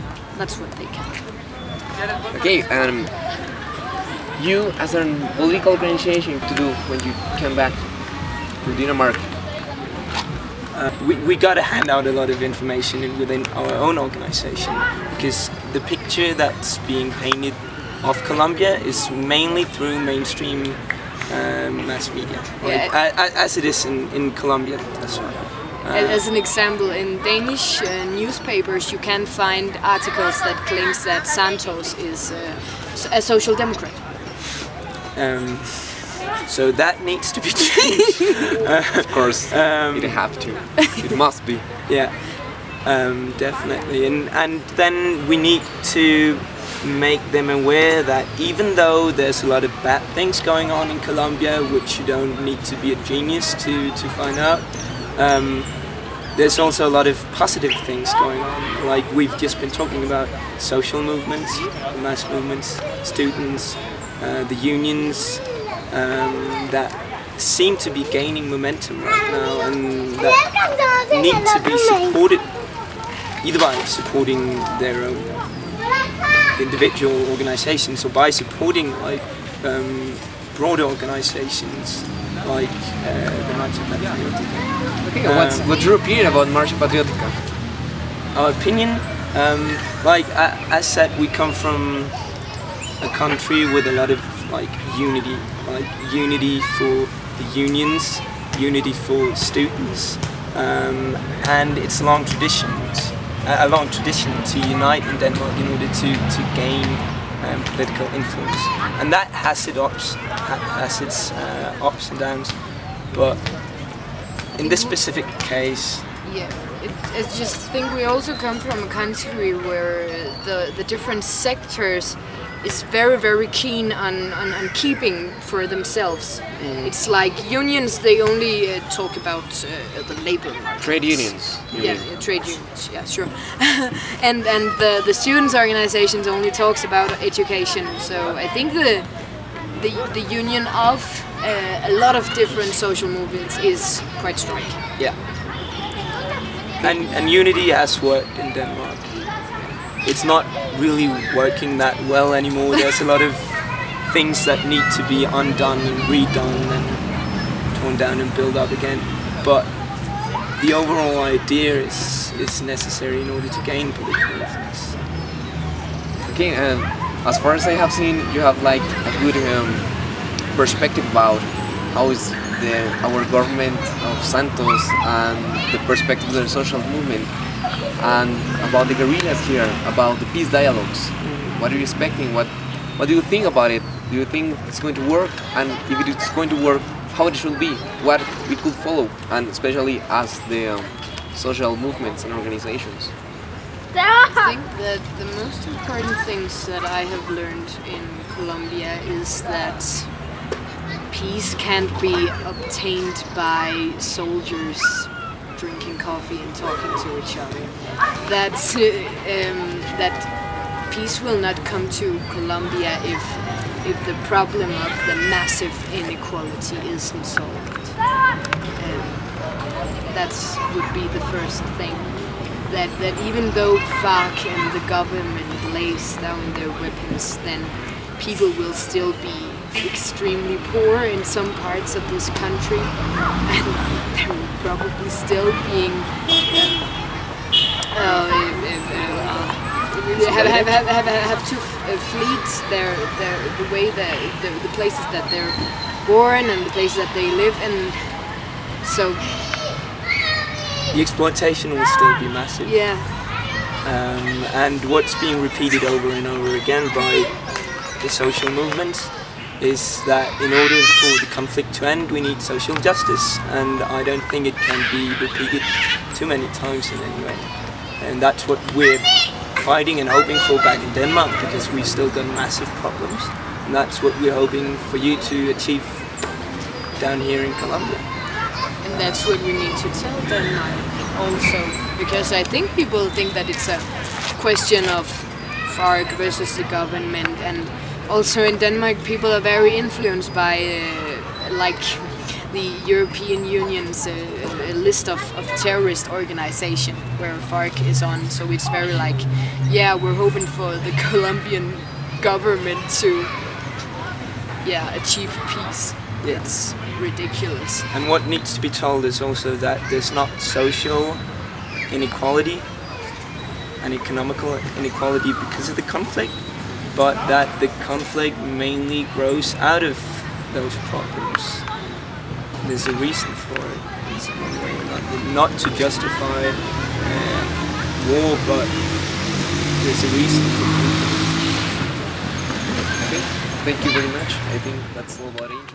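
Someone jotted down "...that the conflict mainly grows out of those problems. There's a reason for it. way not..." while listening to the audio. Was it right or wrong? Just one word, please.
right.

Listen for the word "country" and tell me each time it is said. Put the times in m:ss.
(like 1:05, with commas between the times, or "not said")
1:33, 1:58, 3:52.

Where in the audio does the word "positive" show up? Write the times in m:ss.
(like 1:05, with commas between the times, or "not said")
0:57.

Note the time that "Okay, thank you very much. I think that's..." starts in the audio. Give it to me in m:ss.
5:33.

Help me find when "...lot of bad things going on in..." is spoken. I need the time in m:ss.
0:49.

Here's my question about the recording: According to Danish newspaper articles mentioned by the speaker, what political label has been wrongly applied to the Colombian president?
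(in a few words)
Social democrat.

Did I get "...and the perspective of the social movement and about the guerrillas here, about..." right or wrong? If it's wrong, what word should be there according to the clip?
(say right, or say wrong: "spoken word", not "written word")
right.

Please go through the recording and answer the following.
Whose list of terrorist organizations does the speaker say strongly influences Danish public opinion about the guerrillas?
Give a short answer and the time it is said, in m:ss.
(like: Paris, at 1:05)
European Union, at 4:52.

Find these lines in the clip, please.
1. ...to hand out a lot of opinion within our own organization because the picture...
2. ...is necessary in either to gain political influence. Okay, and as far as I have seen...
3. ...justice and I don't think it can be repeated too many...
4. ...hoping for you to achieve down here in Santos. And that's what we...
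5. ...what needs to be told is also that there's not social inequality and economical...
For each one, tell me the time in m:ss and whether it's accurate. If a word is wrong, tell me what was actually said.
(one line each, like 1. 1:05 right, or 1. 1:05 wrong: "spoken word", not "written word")
1. 0:11 wrong: "information", not "opinion"
2. 2:42 wrong: "order", not "either"
3. 4:22 right
4. 4:34 wrong: "Colombia", not "Santos"
5. 5:08 right.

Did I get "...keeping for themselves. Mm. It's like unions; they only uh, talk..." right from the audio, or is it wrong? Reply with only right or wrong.
right.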